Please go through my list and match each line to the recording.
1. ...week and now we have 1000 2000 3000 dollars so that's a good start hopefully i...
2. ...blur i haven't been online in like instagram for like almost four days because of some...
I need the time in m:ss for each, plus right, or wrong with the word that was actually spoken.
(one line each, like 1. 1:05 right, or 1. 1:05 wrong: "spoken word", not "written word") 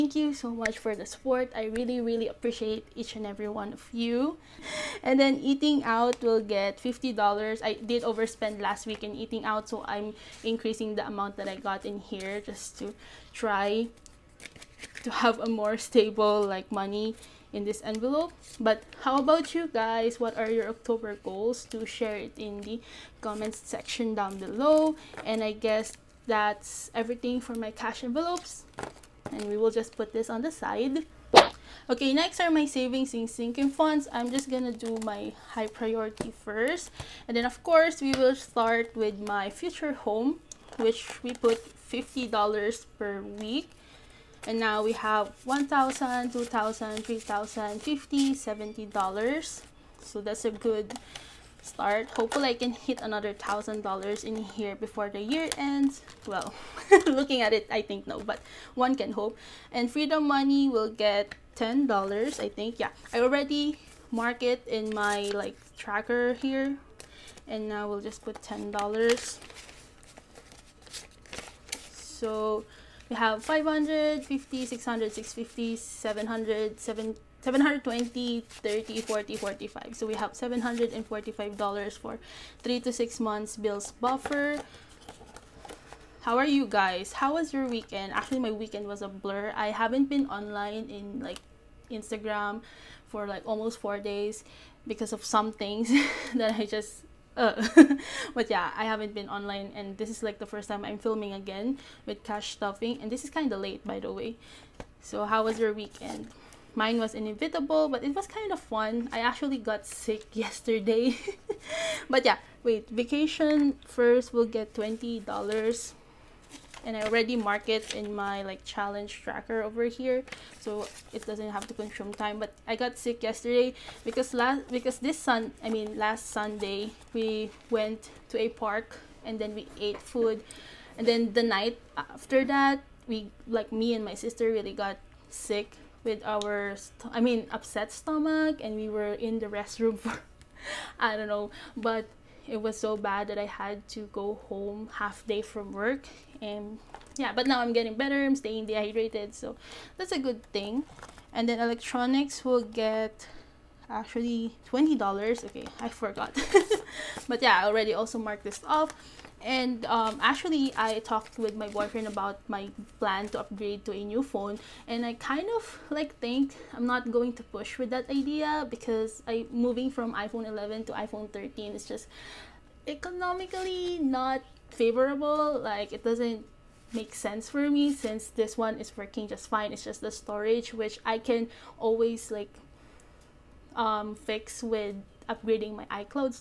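1. 0:43 right
2. 1:29 right.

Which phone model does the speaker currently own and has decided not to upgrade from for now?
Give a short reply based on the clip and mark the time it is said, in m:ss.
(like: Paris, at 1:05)
iPhone 11, at 2:50.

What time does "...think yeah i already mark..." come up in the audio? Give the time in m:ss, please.
1:02.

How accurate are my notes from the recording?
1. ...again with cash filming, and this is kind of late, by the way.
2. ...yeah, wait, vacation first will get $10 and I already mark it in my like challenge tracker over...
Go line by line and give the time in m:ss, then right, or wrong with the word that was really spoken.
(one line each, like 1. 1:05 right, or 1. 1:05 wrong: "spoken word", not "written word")
1. 1:41 wrong: "stuffing", not "filming"
2. 1:52 wrong: "20", not "10".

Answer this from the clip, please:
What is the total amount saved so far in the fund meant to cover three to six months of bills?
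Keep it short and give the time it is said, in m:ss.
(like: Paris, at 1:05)
$745, at 1:20.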